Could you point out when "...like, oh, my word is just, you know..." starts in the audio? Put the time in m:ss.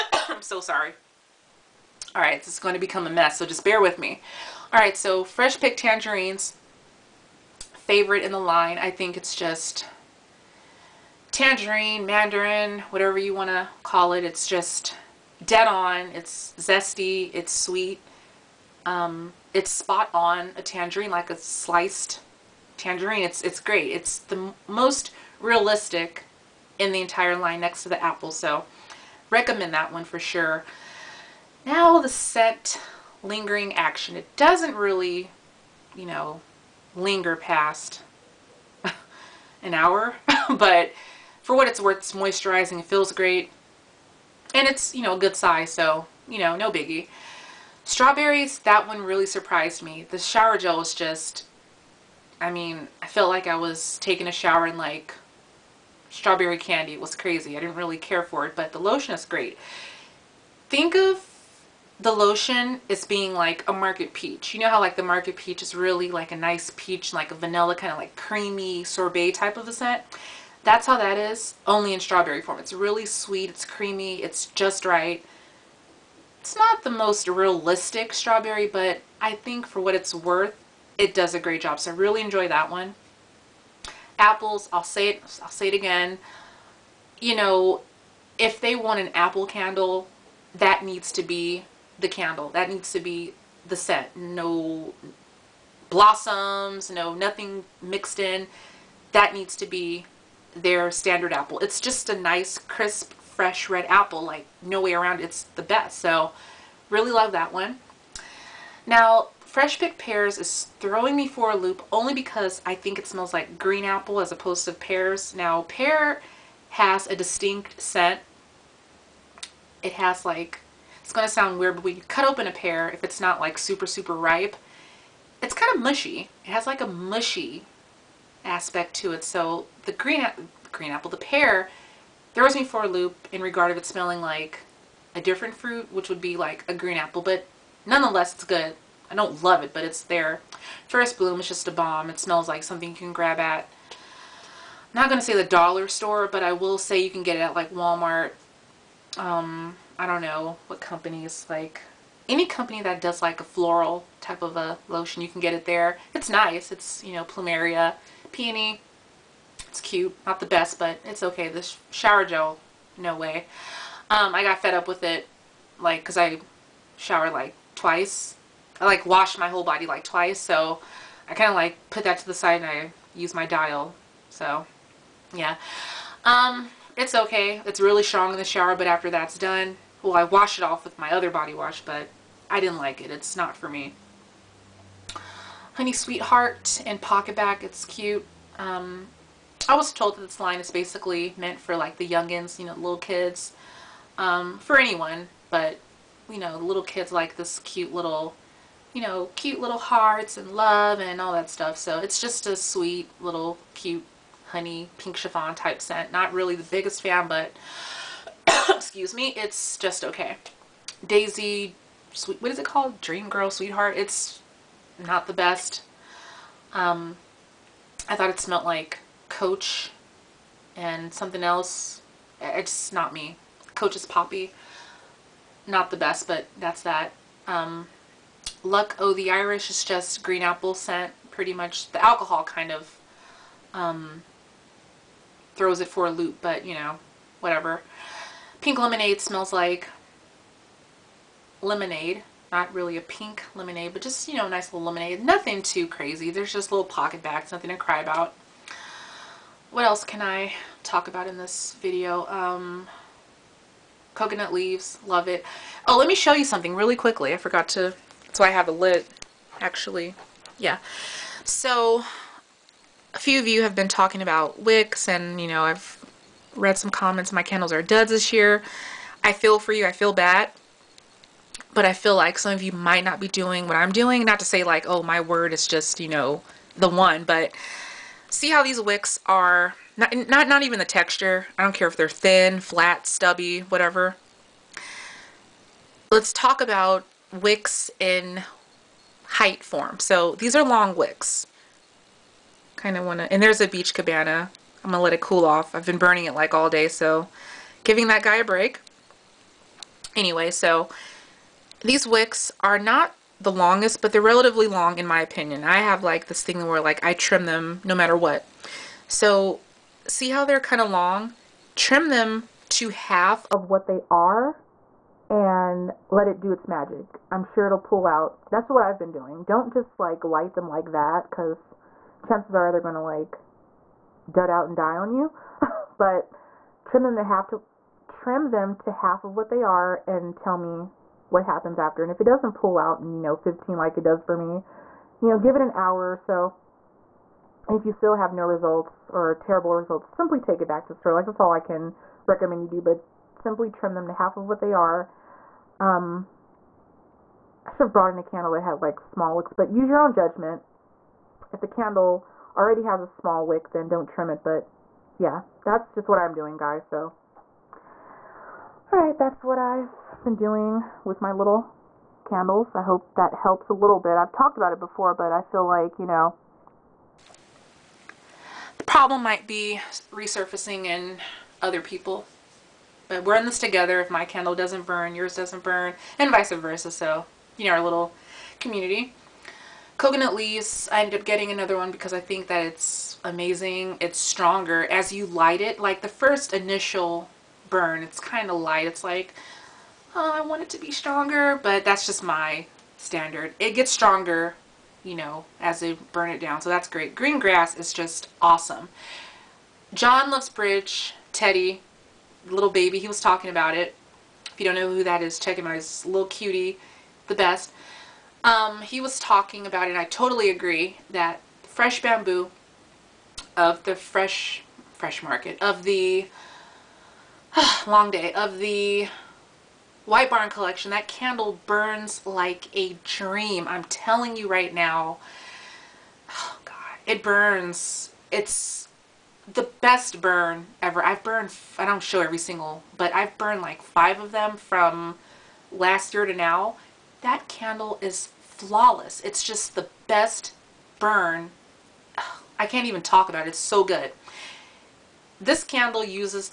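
4:34.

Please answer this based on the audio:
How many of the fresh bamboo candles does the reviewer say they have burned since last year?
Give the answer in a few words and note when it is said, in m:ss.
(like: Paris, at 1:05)
5, at 7:13.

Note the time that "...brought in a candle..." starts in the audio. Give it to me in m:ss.
5:47.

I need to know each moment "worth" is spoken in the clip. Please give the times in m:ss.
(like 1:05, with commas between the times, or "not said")
0:41, 1:20.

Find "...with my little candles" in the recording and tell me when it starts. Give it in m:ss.
6:01.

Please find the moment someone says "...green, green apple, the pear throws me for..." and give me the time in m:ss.
2:09.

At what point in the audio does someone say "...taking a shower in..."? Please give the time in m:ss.
0:53.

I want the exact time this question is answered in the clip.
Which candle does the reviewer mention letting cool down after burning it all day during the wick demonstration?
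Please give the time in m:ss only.
4:53.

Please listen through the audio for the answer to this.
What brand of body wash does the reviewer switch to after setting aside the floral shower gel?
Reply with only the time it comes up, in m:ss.
2:53.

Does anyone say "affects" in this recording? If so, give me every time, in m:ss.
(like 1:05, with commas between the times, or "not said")
not said.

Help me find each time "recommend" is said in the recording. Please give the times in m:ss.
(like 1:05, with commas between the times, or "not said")
0:29, 5:42.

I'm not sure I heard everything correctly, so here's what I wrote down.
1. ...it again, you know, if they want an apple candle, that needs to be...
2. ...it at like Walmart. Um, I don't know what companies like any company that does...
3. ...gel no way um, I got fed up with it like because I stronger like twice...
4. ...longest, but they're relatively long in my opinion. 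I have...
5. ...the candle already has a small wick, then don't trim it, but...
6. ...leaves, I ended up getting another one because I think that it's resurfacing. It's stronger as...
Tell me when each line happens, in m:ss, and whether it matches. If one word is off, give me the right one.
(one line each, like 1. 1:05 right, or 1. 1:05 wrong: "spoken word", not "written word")
1. 1:25 right
2. 2:27 right
3. 2:42 wrong: "shower", not "stronger"
4. 5:03 right
5. 5:51 right
6. 6:20 wrong: "amazing", not "resurfacing".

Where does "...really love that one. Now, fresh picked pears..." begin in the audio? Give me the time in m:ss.
1:46.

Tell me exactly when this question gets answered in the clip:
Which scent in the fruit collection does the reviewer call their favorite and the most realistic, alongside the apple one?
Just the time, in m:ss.
0:05.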